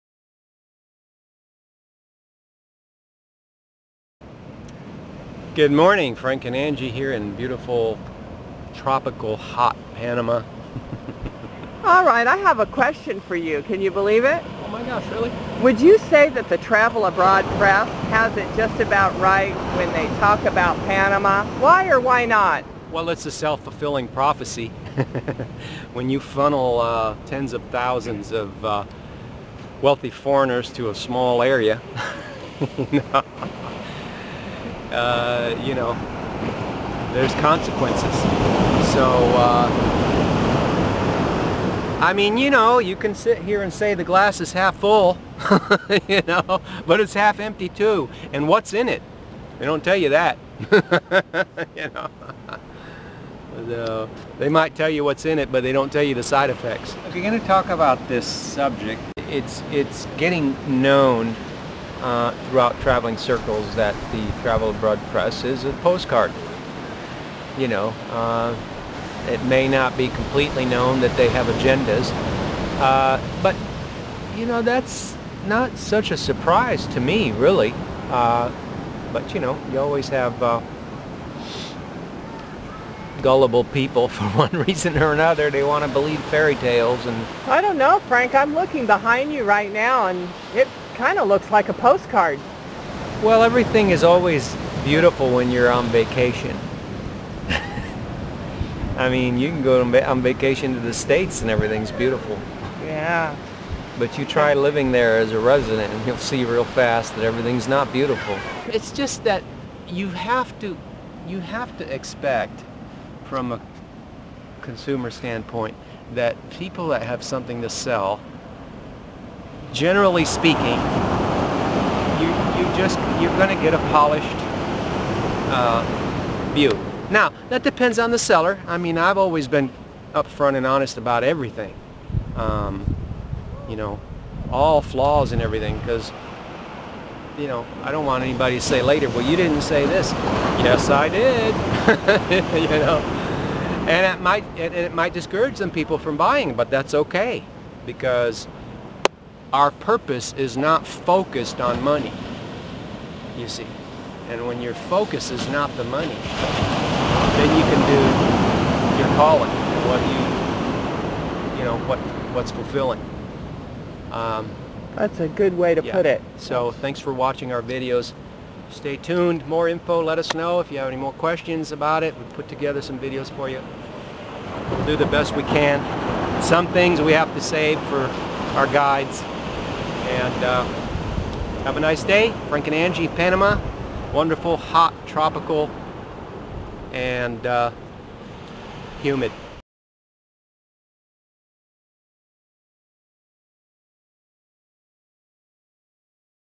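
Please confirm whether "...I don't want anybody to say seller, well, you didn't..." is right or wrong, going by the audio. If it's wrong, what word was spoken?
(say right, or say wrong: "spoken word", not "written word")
wrong: "later", not "seller".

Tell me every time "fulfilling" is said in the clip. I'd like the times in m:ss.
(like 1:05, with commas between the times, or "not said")
0:23, 2:42.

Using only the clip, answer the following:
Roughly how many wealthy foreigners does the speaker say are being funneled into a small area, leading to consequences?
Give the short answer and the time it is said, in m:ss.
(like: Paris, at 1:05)
Tens of thousands, at 0:27.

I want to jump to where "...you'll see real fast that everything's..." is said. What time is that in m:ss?
1:46.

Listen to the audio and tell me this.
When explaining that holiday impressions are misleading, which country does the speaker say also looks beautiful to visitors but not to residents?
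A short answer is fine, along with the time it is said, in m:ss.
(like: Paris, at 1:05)
The States, at 1:40.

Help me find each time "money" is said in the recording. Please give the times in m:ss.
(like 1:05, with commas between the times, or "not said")
2:31, 2:35.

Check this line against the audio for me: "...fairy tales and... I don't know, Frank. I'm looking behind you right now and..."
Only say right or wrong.
right.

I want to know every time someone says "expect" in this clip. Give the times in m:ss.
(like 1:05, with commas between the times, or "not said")
1:51.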